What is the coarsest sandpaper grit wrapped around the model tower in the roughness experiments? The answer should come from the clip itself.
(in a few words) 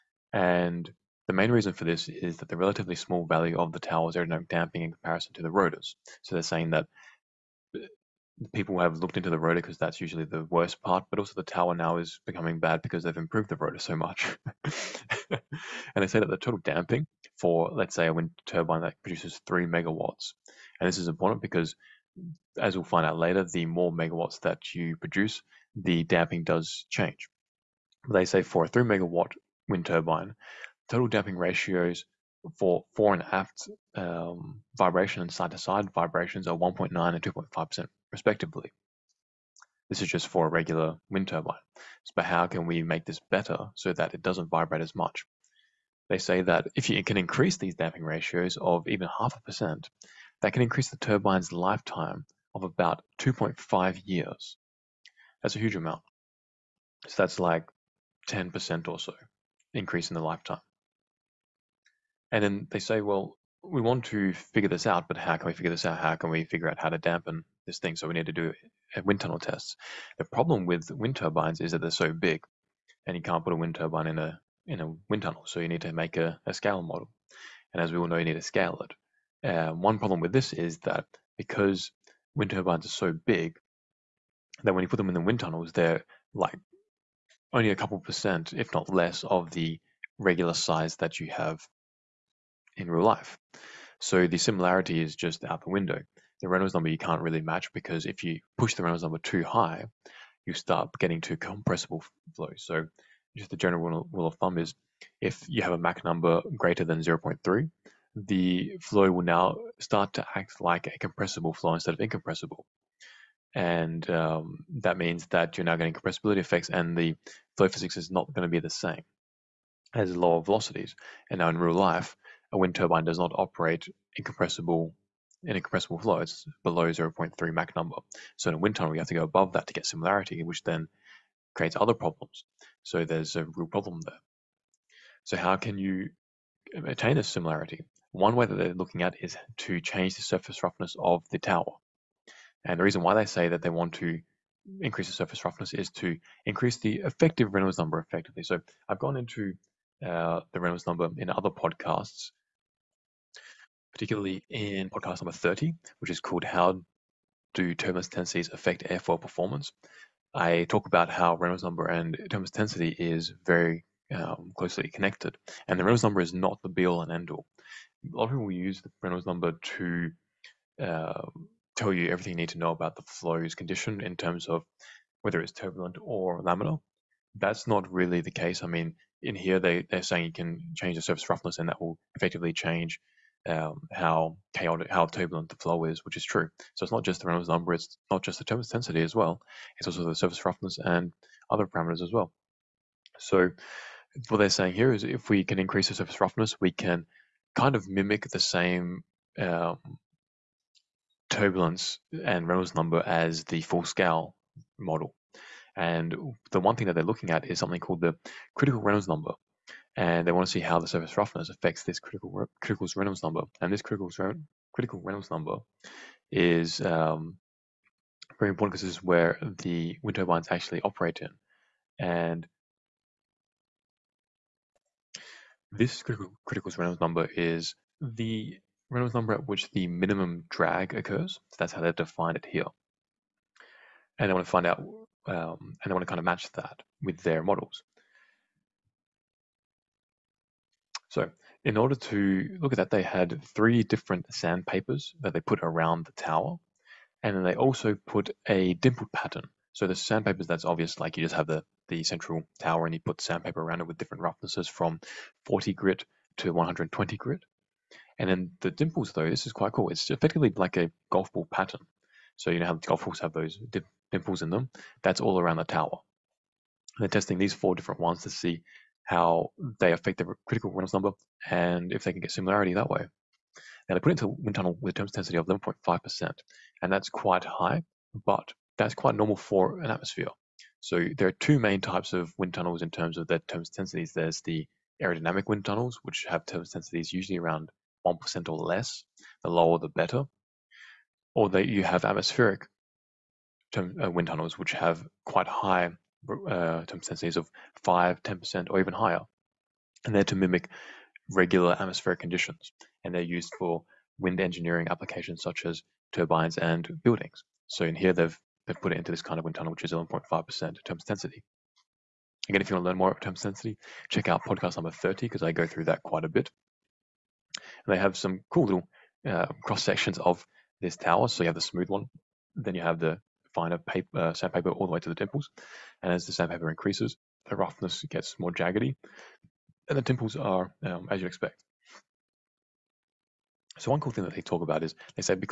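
40 grit.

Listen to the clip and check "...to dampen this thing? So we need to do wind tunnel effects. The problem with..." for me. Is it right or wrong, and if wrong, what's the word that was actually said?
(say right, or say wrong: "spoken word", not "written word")
wrong: "tests", not "effects".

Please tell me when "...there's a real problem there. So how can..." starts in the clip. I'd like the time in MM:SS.
02:13.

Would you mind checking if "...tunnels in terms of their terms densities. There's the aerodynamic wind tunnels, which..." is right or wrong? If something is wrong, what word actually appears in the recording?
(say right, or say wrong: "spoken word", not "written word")
right.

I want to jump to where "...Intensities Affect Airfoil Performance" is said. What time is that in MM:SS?
02:38.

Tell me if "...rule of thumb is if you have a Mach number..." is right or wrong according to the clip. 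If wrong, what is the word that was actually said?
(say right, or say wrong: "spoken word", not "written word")
right.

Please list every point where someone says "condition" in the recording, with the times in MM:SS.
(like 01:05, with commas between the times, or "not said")
02:53, 05:02.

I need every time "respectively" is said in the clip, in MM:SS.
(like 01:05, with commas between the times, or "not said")
00:38.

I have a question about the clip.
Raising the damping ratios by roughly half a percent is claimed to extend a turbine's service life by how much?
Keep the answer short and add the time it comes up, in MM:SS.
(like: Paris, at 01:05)
2.5 years, at 00:53.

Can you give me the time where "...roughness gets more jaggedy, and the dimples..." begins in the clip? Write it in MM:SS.
05:27.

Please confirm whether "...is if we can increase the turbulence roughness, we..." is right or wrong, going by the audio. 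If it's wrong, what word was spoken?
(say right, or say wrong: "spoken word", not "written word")
wrong: "surface", not "turbulence".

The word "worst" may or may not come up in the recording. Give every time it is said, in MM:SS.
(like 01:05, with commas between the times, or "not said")
00:10.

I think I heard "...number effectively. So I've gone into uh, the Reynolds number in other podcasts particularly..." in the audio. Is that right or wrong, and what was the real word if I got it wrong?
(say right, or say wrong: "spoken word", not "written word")
right.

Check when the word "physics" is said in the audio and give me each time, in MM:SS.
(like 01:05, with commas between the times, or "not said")
01:57.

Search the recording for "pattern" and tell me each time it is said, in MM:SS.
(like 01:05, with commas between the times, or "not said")
04:09, 04:21.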